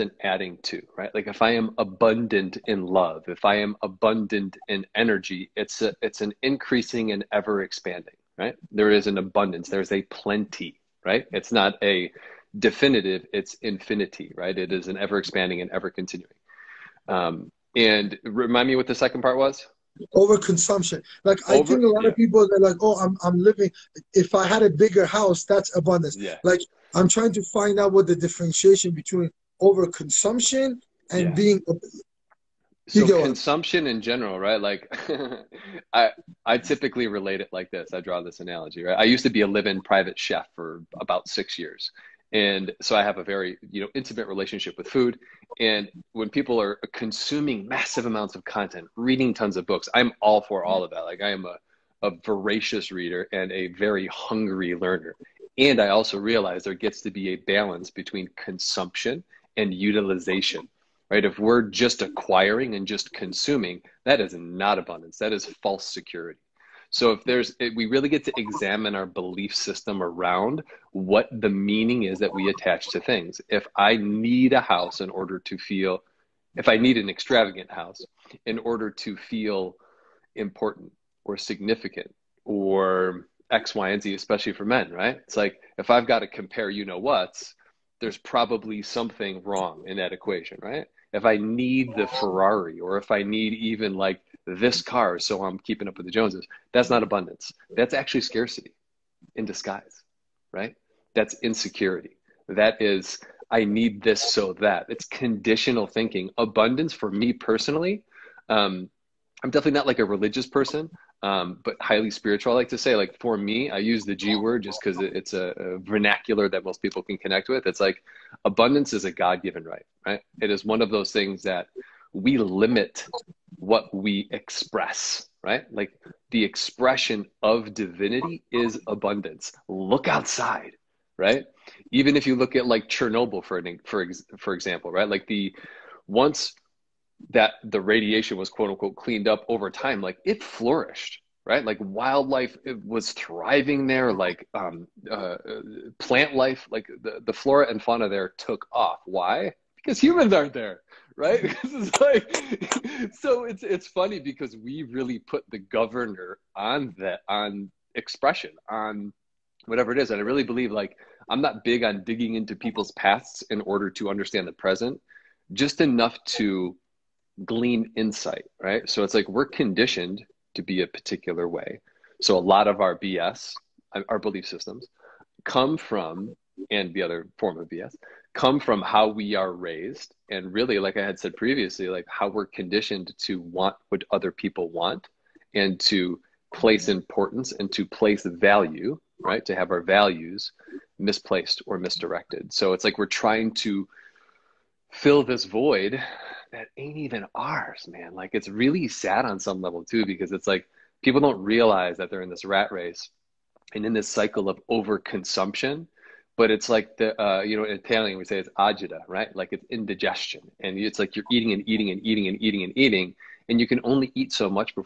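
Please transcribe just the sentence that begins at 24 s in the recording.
If I had a bigger house, that's abundance.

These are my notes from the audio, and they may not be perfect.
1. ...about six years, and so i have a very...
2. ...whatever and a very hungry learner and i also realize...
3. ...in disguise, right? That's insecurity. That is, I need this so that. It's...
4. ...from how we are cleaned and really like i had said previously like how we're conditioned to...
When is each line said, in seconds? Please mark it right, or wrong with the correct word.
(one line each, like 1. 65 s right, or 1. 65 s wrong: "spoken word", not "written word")
1. 41 s right
2. 52 s wrong: "reader", not "whatever"
3. 99 s right
4. 178 s wrong: "raised", not "cleaned".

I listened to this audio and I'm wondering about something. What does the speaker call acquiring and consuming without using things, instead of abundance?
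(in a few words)
false security.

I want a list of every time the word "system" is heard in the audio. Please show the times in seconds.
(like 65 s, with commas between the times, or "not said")
69 s, 174 s.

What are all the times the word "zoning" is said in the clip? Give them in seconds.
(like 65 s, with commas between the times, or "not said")
not said.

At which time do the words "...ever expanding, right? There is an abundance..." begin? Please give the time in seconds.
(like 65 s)
7 s.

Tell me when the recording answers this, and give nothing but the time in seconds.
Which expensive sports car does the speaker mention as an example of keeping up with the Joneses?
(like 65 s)
92 s.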